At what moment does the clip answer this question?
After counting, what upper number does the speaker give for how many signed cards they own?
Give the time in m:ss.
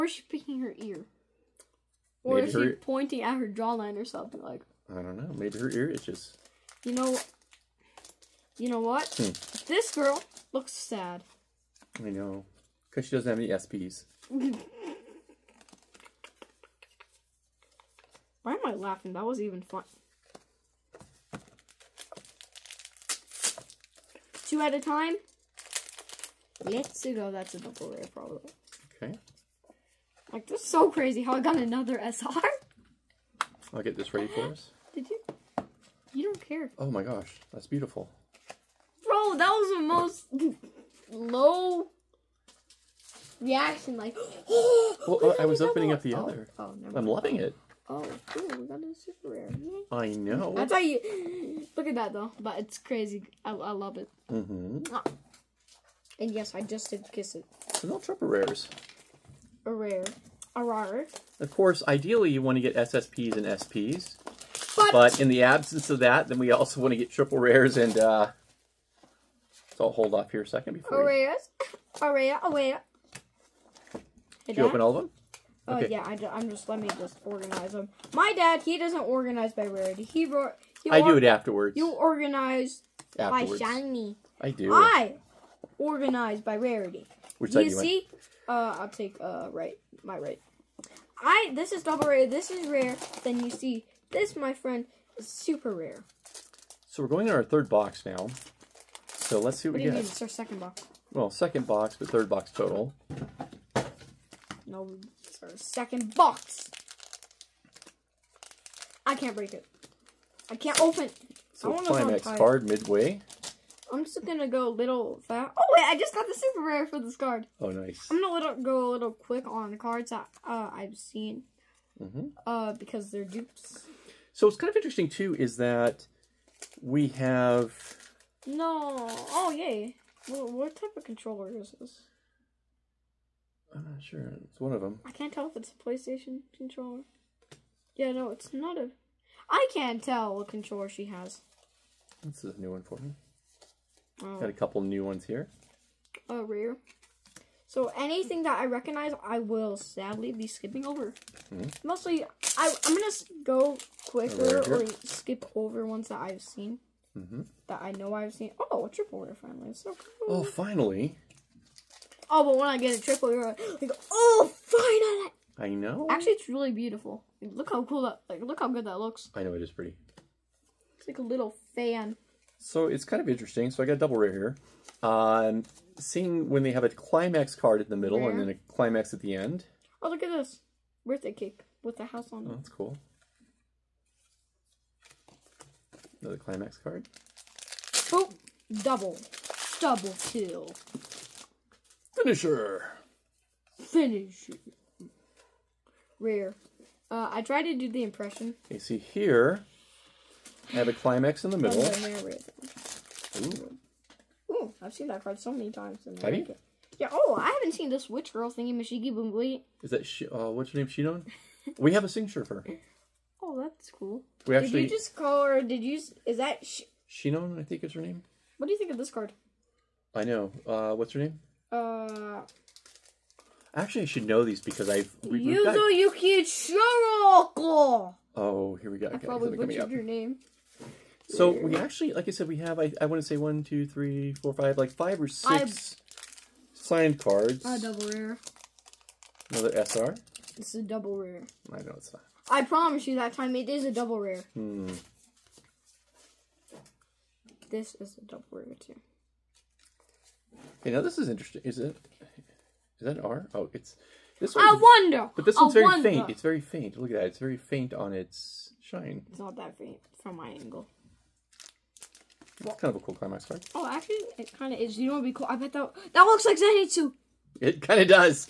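3:55.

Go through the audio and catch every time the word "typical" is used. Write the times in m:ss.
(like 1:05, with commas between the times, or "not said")
not said.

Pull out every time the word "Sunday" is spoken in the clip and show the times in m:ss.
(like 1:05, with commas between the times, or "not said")
not said.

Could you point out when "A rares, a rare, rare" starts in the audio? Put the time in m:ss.
1:11.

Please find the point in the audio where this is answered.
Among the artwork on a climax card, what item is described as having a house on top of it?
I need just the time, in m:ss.
3:01.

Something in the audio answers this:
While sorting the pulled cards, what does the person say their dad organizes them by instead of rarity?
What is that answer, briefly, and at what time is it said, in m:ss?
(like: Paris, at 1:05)
Shiny, at 1:23.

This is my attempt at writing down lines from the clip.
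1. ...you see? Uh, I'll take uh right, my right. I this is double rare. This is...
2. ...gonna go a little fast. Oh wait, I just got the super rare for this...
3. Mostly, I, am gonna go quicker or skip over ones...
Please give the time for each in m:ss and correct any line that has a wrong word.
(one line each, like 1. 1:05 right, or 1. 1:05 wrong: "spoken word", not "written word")
1. 1:27 right
2. 1:54 right
3. 2:31 right.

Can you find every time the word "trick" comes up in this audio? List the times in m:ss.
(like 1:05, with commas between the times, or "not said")
not said.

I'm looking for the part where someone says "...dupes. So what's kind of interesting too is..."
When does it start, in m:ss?
2:03.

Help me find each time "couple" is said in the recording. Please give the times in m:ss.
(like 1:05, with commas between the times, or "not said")
2:24.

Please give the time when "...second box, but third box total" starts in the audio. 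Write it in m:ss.
1:41.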